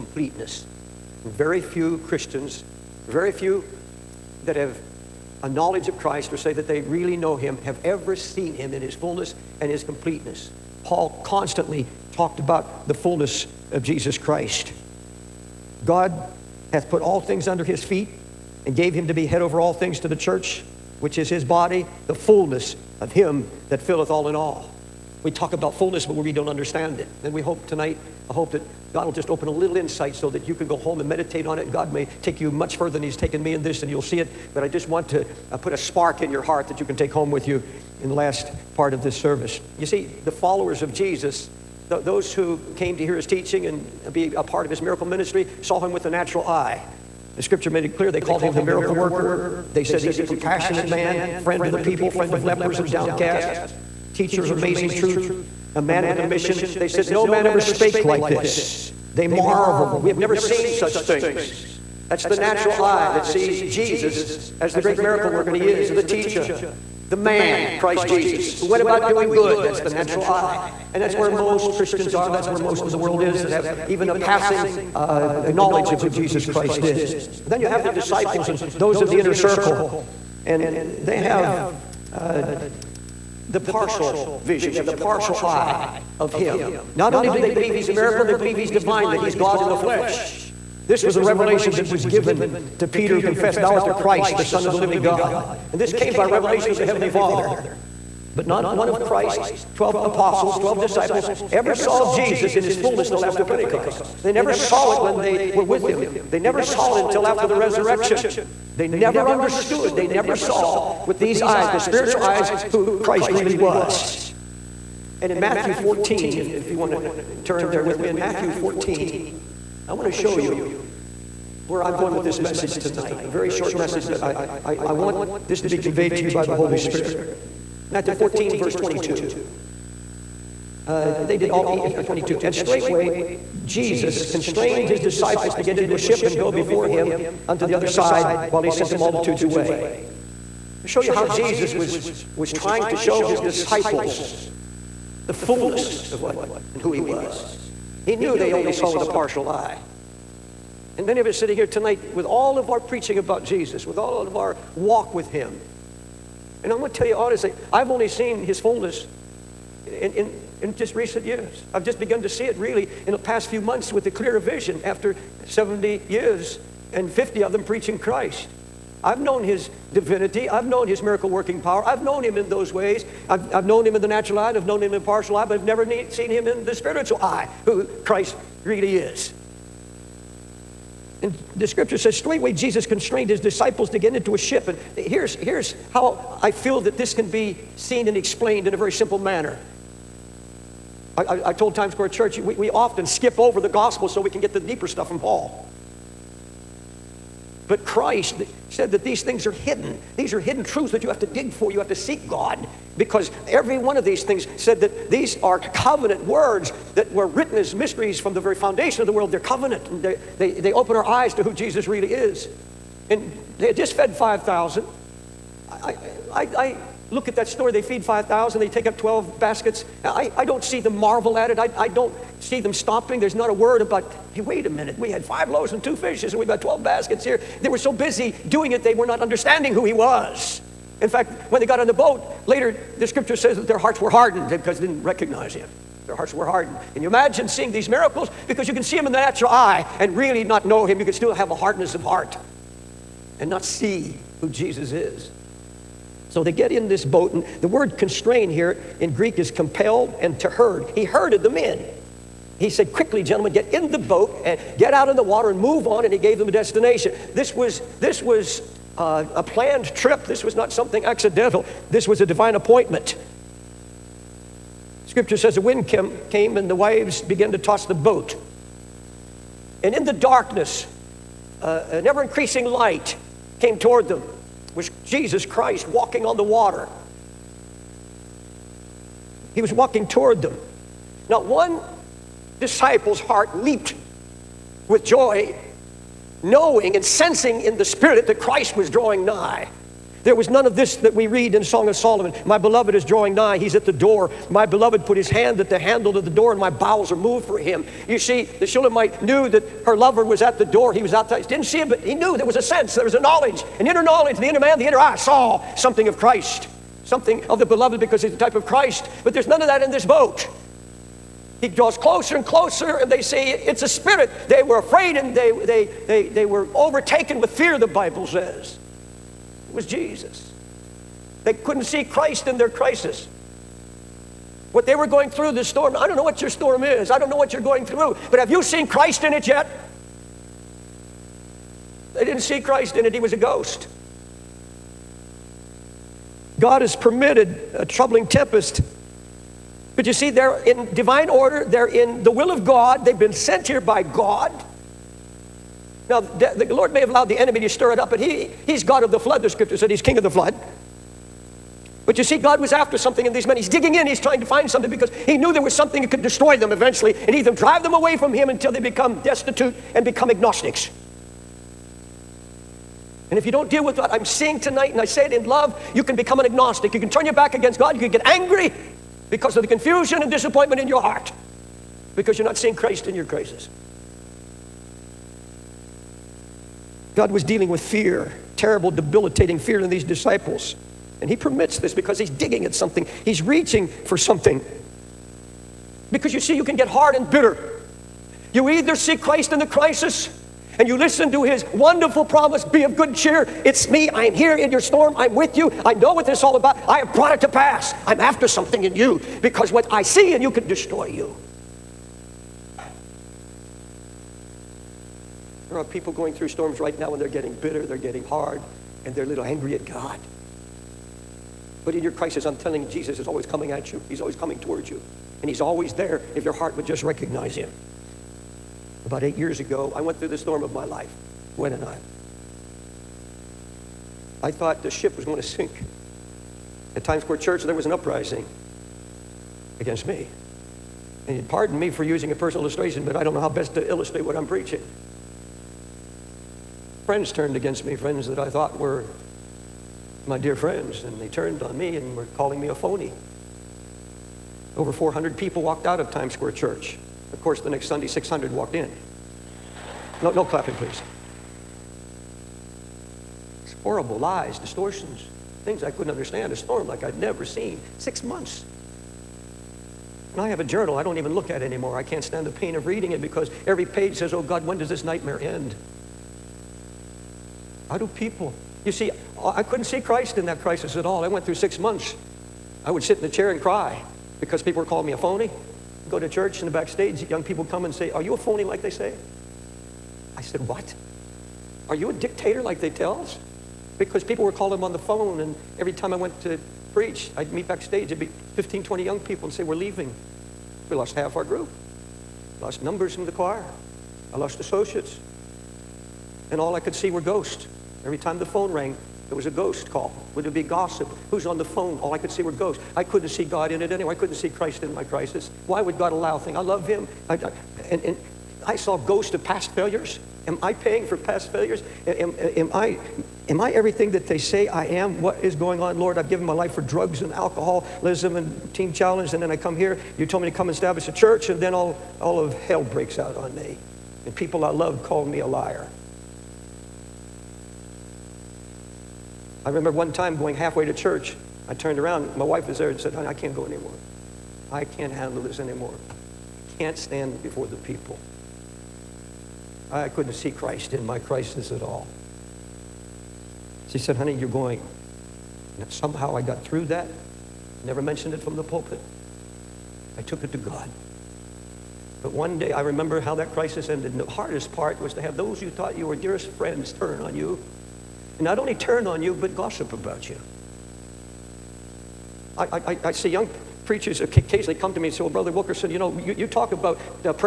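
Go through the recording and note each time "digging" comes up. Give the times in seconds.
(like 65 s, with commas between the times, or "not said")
353 s, 382 s.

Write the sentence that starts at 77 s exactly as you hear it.
Then you have the disciples and those in the inner circle.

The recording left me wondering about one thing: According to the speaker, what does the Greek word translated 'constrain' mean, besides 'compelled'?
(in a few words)
To herd.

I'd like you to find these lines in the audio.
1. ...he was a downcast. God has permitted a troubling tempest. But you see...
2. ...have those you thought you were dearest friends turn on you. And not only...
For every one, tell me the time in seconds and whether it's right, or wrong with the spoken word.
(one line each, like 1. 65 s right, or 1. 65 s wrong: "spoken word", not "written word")
1. 333 s wrong: "ghost", not "downcast"
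2. 555 s right.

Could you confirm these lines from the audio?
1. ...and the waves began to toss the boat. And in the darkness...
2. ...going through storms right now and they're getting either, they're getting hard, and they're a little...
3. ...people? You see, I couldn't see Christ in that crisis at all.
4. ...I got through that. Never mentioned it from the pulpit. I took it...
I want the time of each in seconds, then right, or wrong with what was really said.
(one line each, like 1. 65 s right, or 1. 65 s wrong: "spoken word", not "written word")
1. 266 s right
2. 406 s wrong: "bitter", not "either"
3. 468 s right
4. 546 s right.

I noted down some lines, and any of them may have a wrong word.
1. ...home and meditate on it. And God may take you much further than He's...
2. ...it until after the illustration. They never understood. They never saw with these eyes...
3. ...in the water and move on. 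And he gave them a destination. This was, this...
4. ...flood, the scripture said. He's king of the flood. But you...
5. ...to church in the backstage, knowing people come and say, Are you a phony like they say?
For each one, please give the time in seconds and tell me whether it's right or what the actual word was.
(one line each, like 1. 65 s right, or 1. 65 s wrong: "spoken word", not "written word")
1. 30 s right
2. 106 s wrong: "resurrection", not "illustration"
3. 255 s right
4. 349 s right
5. 476 s wrong: "young", not "knowing".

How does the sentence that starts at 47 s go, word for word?
The scripture made it clear they called him the miracle worker.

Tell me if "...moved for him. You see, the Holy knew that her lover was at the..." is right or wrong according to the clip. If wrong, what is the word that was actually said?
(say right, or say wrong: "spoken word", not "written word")
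wrong: "Shulamite", not "Holy".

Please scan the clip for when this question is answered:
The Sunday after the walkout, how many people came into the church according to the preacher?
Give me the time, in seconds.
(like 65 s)
448 s.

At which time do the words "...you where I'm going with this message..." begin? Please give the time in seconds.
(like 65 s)
120 s.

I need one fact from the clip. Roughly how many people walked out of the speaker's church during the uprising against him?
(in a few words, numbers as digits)
Over 400.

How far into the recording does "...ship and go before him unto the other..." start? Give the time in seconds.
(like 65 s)
135 s.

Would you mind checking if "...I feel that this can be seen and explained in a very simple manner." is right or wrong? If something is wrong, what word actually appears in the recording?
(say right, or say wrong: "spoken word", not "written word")
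right.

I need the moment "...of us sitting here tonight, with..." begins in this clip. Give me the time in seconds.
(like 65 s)
151 s.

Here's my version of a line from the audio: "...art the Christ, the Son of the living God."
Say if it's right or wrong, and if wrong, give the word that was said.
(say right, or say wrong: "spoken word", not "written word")
right.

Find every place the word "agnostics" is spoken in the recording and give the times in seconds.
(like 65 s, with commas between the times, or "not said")
360 s, 366 s.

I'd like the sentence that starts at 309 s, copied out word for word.
But there's none of that in this boat.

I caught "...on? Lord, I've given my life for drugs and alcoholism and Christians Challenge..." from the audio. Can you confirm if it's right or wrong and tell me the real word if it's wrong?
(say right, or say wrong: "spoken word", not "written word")
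wrong: "Teen", not "Christians".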